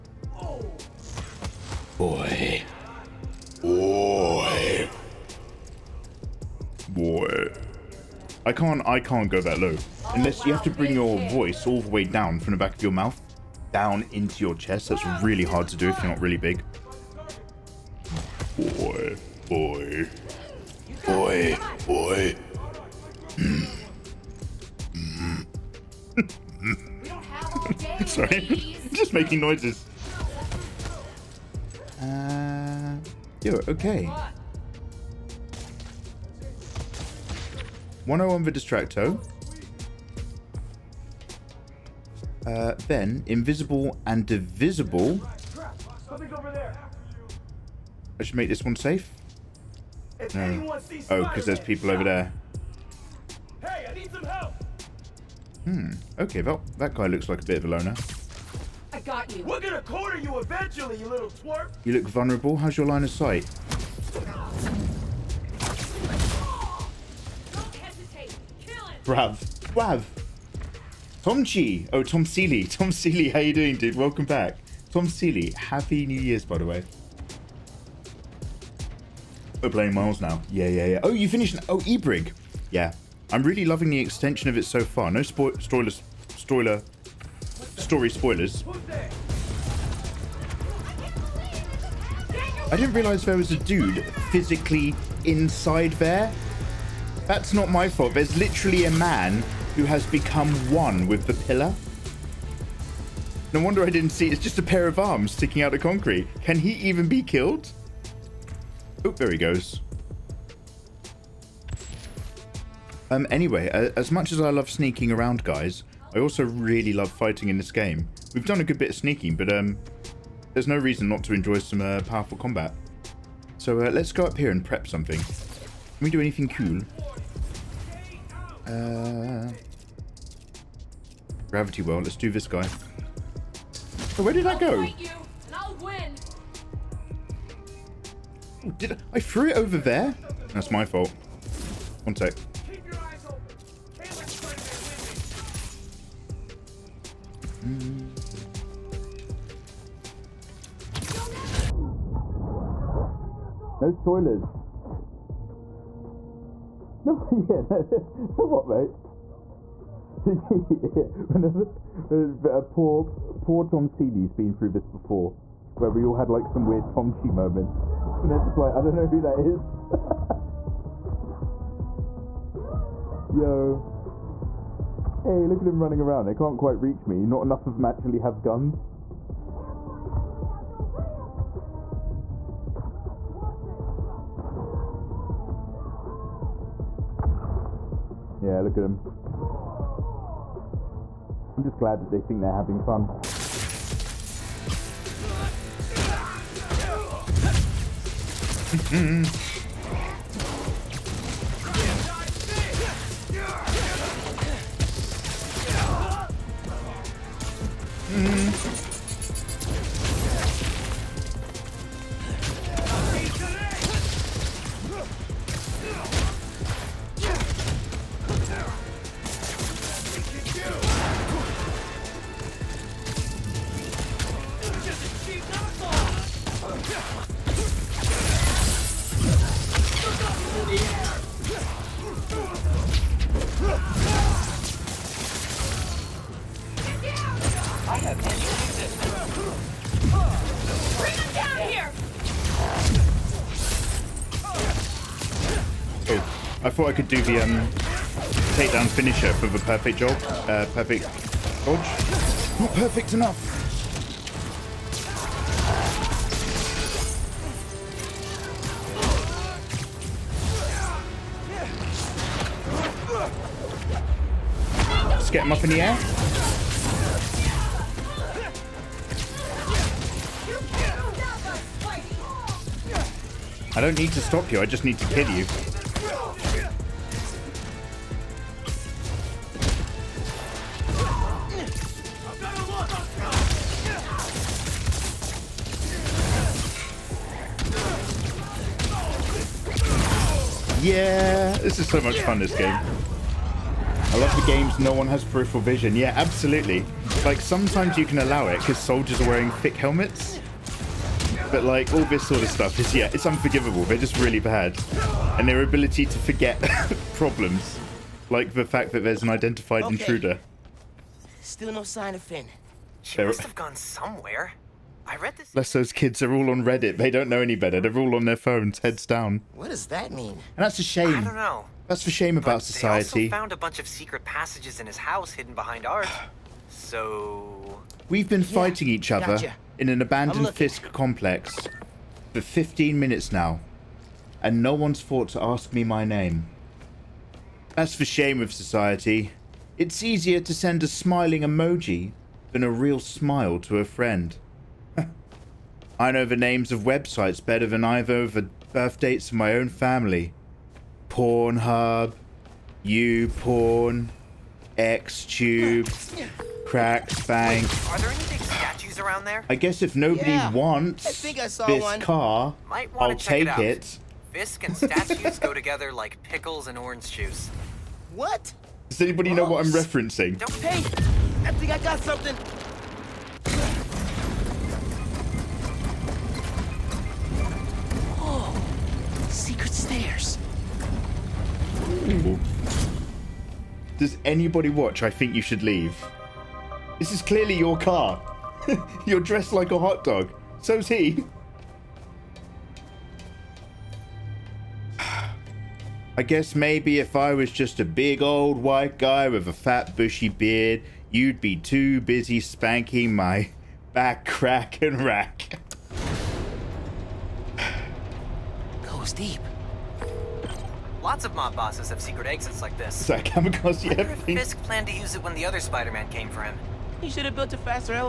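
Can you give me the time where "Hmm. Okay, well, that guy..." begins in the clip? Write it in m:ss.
0:55.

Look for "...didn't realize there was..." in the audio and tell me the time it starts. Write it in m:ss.
1:32.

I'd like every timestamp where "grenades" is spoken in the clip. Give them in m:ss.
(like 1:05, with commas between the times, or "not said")
not said.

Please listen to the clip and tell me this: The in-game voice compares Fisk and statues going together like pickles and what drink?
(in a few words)
Orange juice.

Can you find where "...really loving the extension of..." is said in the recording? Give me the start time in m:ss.
1:23.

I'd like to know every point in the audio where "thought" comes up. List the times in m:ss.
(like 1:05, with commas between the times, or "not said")
4:06, 5:34.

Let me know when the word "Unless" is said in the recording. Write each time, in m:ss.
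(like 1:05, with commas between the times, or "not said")
0:10, 5:15.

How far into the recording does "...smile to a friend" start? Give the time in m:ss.
5:42.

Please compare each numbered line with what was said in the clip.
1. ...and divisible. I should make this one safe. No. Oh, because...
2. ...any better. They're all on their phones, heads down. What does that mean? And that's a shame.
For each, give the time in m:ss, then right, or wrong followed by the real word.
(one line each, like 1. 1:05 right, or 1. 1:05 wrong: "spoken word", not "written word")
1. 0:44 right
2. 5:17 right.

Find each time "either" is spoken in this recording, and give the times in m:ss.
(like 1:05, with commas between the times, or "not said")
5:47.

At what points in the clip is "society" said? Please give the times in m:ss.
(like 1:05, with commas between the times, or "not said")
5:22, 5:38.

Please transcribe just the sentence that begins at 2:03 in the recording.
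So uh, let's go up here and prep something.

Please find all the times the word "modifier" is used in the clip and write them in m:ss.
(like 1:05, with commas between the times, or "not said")
not said.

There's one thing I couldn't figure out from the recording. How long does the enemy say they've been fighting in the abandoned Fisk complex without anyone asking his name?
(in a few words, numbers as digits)
15 minutes.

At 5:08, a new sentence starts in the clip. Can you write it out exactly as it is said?
Like the fact that there's an identified okay.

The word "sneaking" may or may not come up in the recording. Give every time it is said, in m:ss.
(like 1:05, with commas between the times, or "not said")
1:54, 1:58.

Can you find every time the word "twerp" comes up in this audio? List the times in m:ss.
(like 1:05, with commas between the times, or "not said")
1:01.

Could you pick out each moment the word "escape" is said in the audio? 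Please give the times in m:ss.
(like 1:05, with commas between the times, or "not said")
not said.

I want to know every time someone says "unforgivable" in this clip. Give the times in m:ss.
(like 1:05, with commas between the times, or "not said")
5:03.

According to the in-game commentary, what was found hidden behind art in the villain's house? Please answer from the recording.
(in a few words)
Secret passages.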